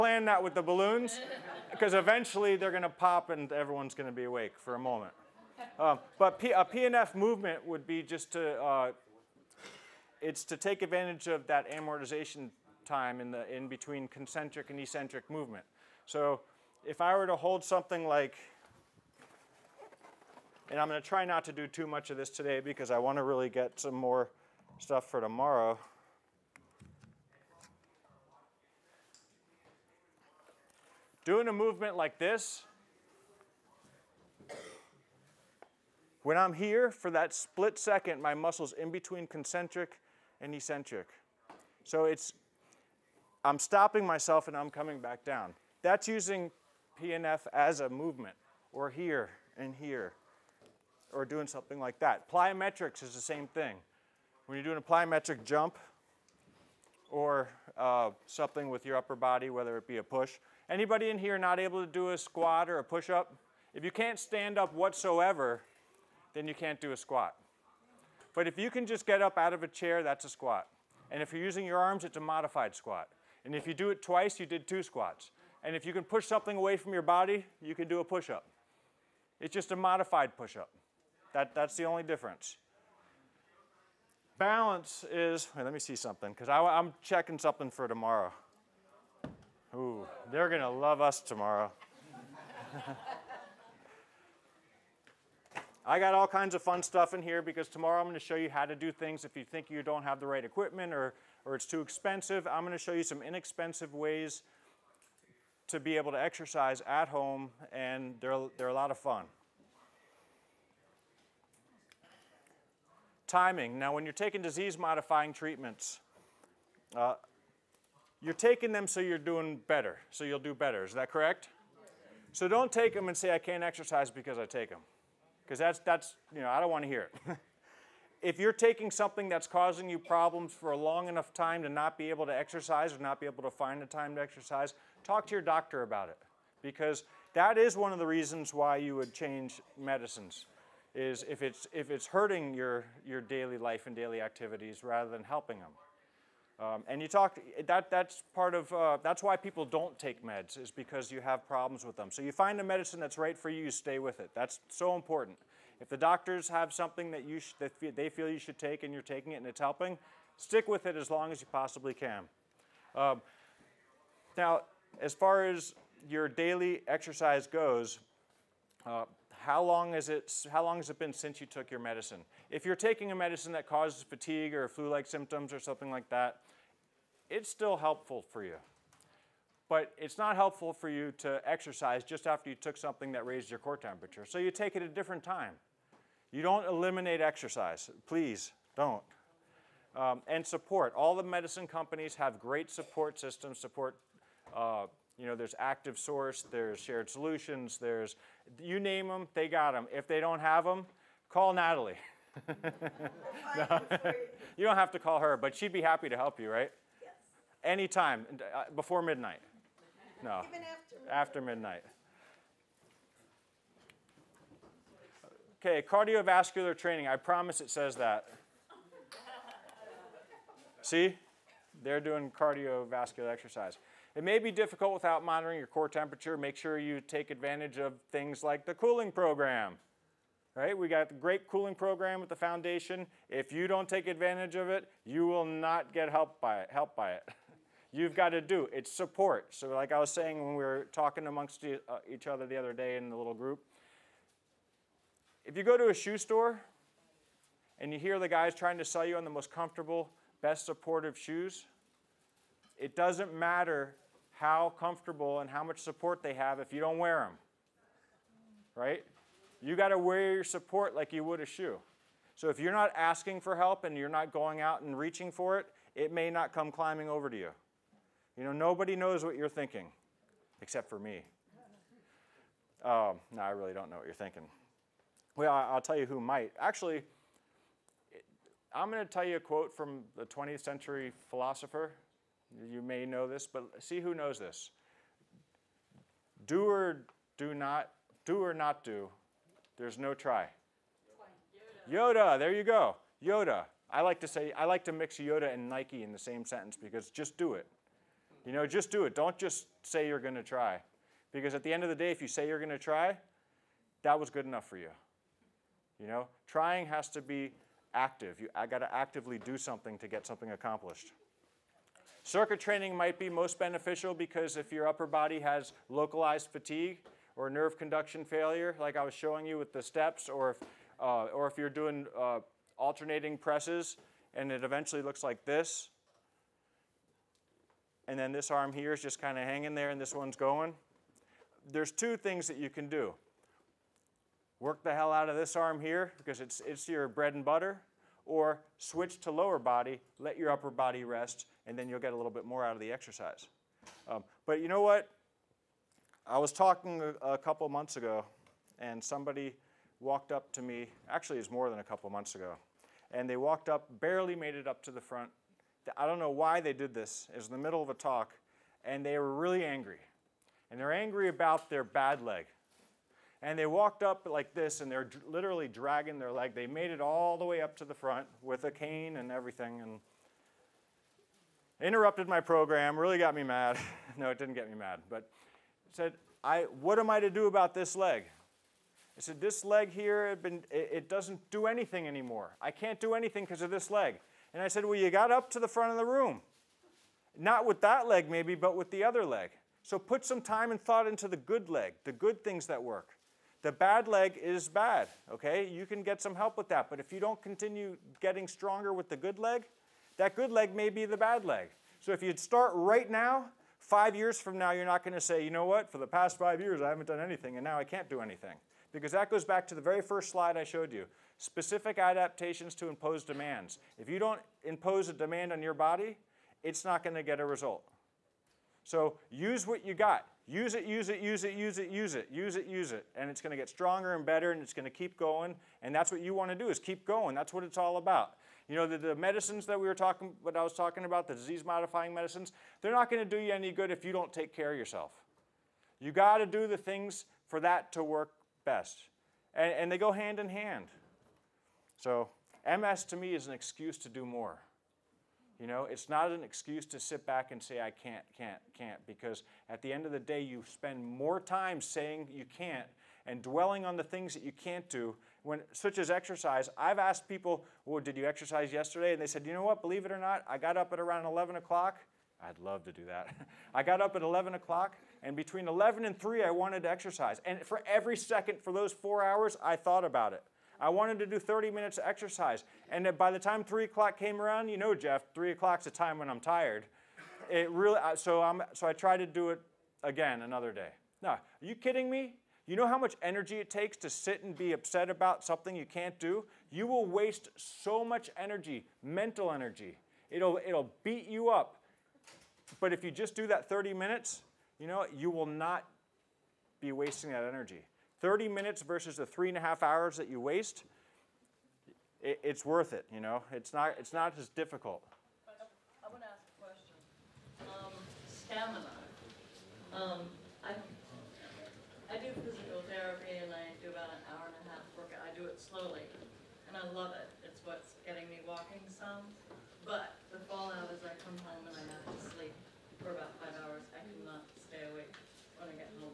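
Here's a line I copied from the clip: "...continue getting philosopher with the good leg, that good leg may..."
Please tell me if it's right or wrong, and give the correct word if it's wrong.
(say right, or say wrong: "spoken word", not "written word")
wrong: "stronger", not "philosopher".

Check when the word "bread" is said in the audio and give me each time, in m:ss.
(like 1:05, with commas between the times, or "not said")
5:37.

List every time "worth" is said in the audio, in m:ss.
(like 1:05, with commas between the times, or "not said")
8:22.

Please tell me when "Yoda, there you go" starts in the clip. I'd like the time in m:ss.
4:52.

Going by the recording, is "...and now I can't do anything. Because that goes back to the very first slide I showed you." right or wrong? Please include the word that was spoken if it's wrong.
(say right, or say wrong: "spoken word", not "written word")
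right.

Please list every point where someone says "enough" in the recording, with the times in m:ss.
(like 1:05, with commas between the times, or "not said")
2:11, 5:04.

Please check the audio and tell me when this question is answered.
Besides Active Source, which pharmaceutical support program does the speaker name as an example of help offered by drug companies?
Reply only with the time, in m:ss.
3:16.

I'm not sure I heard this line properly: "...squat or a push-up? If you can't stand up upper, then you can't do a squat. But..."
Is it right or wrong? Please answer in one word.
wrong.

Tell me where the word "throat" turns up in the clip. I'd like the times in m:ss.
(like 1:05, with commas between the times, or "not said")
not said.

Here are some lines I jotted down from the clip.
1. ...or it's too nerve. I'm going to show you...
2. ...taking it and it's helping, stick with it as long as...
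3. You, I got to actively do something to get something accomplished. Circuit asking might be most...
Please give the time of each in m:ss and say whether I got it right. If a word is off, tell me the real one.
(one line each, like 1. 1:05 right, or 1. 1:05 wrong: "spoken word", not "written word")
1. 1:41 wrong: "expensive", not "nerve"
2. 2:39 right
3. 5:08 wrong: "training", not "asking".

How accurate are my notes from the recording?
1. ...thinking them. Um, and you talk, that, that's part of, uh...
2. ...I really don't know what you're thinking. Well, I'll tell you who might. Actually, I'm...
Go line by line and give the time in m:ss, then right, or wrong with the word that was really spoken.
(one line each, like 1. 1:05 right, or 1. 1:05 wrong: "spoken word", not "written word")
1. 2:25 wrong: "helping", not "thinking"
2. 4:33 right.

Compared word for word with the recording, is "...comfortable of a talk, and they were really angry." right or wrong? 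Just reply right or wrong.
wrong.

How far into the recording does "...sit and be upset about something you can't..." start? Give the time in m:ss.
8:04.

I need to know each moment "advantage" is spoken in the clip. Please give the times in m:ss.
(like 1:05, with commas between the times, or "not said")
0:10, 3:47, 3:54.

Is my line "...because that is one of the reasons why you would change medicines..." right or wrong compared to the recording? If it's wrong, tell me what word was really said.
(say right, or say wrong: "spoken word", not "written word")
right.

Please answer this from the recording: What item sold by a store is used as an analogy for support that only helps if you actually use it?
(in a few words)
shoes.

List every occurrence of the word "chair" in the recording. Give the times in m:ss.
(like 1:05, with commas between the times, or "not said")
1:09.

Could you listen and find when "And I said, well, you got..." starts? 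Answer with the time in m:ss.
6:24.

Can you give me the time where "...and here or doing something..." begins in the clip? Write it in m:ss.
0:49.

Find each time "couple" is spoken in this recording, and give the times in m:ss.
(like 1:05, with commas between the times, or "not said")
5:47, 5:51.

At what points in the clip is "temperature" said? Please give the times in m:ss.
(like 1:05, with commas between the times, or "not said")
3:03, 3:45.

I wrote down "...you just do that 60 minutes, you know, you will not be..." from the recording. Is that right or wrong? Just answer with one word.
wrong.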